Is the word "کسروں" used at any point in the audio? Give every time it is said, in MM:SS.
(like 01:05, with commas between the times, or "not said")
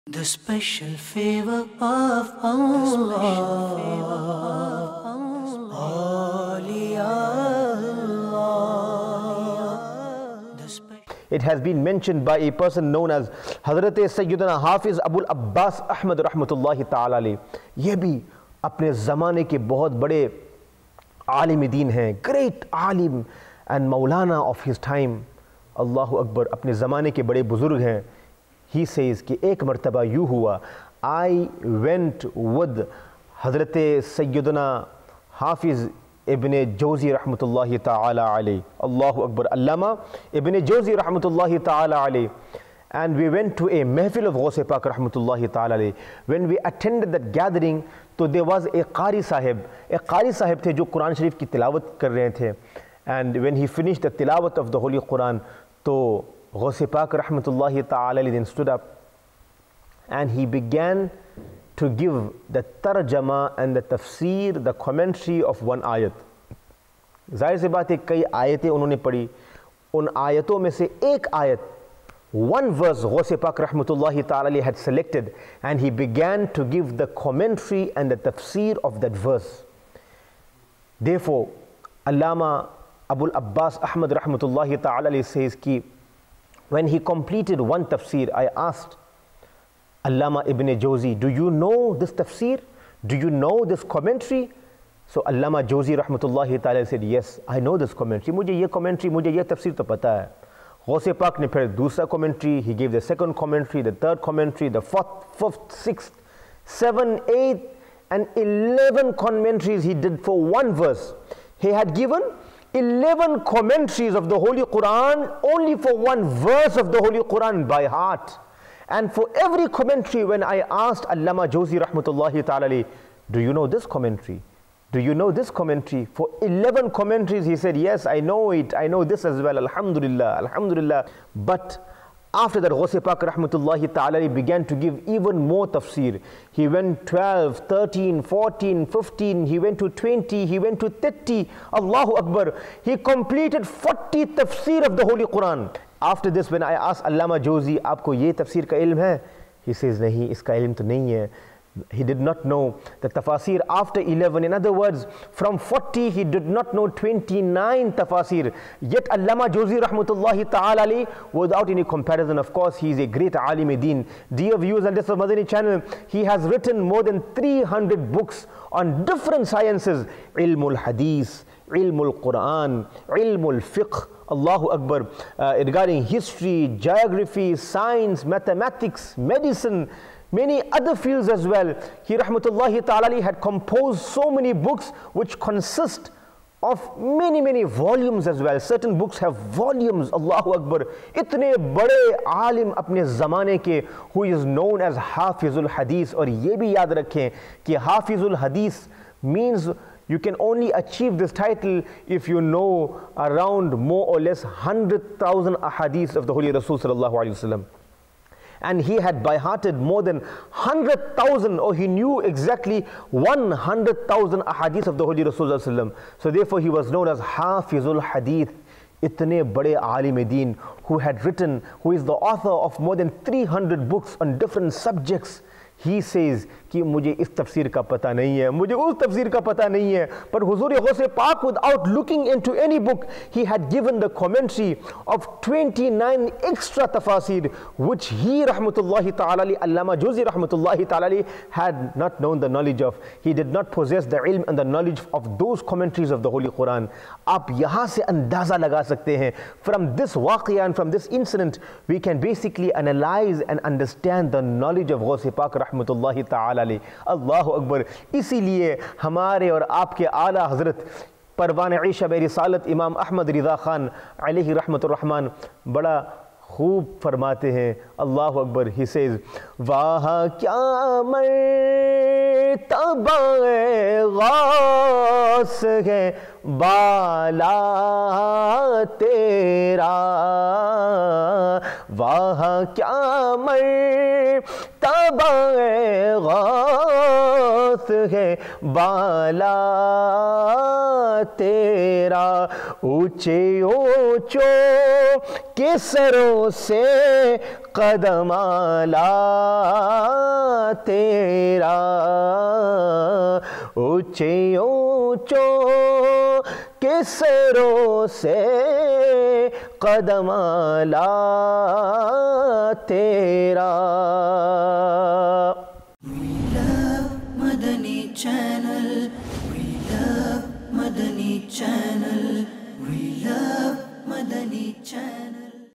04:55, 05:06.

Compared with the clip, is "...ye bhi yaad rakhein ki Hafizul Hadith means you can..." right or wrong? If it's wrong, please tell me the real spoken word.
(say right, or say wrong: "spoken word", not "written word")
right.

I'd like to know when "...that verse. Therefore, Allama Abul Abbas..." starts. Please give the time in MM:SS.
01:19.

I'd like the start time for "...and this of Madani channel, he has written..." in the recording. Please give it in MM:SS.
02:44.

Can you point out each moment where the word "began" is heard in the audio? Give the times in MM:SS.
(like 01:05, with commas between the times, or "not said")
01:00, 01:15, 02:14.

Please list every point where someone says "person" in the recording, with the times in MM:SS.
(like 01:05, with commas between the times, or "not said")
00:12.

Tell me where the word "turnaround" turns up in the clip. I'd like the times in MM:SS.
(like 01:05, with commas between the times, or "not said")
not said.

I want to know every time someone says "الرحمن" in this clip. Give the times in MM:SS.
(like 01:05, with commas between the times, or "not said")
04:24.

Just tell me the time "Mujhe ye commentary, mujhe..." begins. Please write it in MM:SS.
01:38.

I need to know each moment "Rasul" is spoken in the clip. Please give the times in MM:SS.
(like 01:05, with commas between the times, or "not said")
03:26, 03:35.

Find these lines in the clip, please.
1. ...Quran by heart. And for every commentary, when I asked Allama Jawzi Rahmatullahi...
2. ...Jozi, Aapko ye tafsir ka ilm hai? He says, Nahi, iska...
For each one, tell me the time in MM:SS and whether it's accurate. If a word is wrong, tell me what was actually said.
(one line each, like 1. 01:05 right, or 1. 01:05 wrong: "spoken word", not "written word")
1. 01:57 right
2. 02:27 right.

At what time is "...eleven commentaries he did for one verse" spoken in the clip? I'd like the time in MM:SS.
01:48.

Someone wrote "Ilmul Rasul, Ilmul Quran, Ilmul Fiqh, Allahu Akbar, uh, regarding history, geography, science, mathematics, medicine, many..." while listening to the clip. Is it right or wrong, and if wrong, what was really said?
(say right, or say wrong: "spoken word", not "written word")
wrong: "Hadith", not "Rasul".